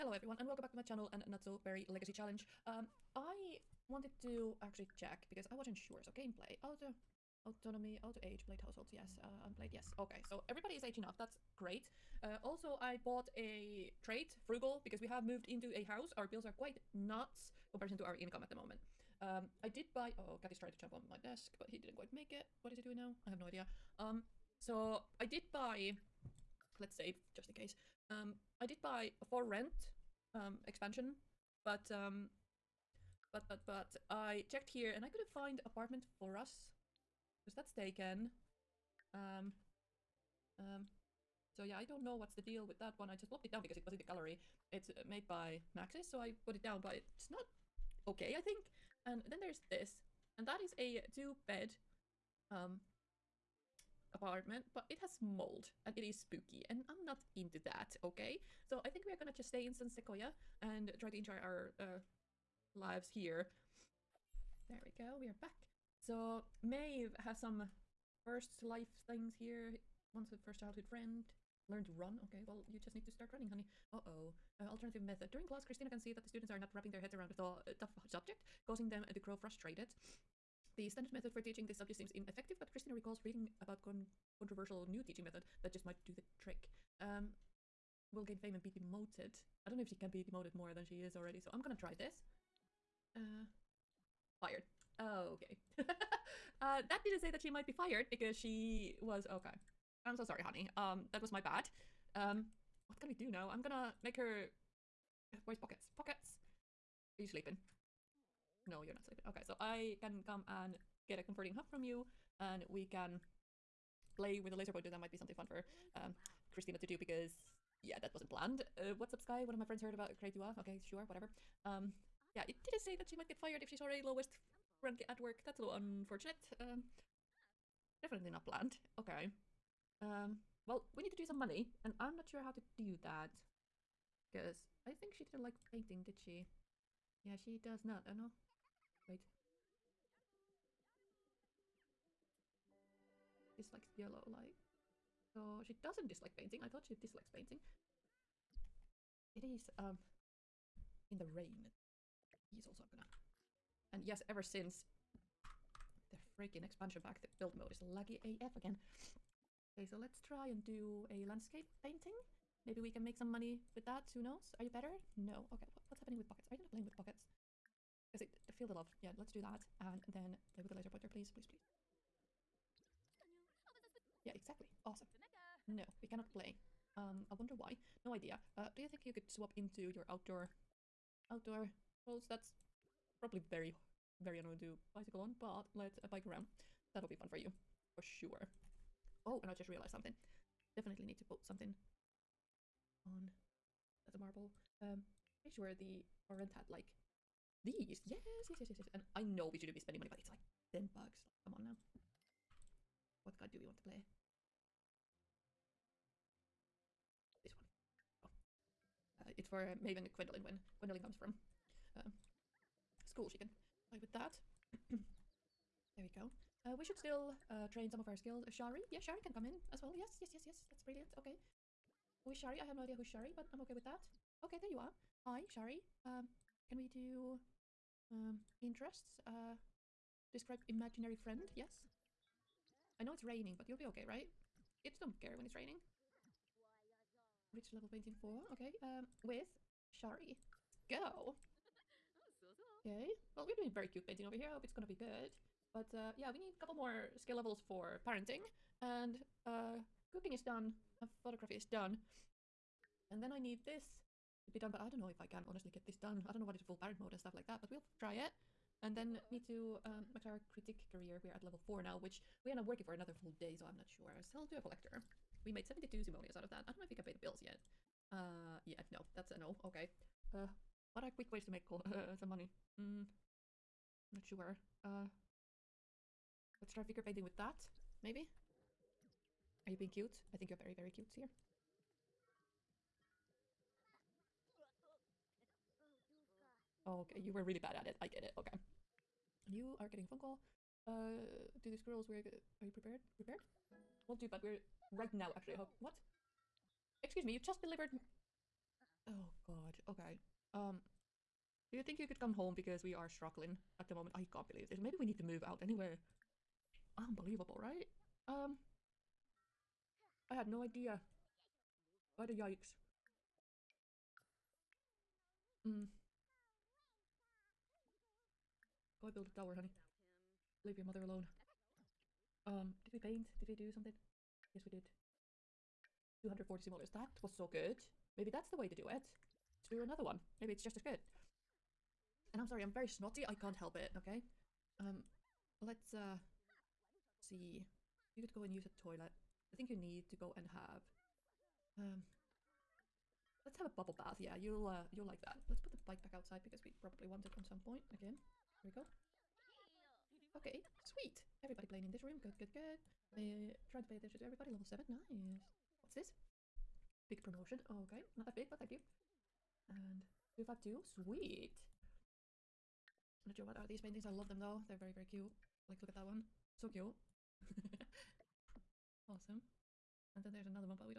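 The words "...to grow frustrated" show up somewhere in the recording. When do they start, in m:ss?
1:19.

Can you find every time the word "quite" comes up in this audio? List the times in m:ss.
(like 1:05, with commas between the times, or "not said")
0:16, 0:21.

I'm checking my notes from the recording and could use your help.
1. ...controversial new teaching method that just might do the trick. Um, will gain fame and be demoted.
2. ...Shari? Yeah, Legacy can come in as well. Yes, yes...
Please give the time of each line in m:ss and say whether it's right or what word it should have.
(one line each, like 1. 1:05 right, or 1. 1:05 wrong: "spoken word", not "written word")
1. 1:24 right
2. 3:38 wrong: "Shari", not "Legacy".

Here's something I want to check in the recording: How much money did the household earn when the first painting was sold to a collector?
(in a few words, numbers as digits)
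72 simoleons.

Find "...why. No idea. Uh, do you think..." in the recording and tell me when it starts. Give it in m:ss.
2:57.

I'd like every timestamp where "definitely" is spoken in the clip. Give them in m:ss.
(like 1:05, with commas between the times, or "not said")
2:08, 3:10.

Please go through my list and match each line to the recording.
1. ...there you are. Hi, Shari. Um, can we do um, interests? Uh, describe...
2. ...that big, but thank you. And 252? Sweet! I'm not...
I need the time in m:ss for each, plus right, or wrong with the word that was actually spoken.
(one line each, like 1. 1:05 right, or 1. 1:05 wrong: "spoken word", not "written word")
1. 3:44 right
2. 5:58 right.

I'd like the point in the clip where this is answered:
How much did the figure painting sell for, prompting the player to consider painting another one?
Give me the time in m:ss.
5:26.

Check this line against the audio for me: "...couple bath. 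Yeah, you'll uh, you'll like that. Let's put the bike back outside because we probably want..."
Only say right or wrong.
wrong.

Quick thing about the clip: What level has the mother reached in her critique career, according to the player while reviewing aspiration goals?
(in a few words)
Level 4.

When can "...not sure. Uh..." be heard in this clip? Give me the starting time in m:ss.
4:34.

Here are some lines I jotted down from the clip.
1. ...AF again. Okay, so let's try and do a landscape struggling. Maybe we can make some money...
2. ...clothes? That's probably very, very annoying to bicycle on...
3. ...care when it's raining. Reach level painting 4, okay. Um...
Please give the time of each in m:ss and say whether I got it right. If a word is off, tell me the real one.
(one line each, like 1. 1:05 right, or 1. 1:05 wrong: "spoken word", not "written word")
1. 2:38 wrong: "painting", not "struggling"
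2. 3:02 right
3. 3:55 right.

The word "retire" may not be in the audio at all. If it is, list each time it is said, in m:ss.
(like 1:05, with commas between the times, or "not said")
not said.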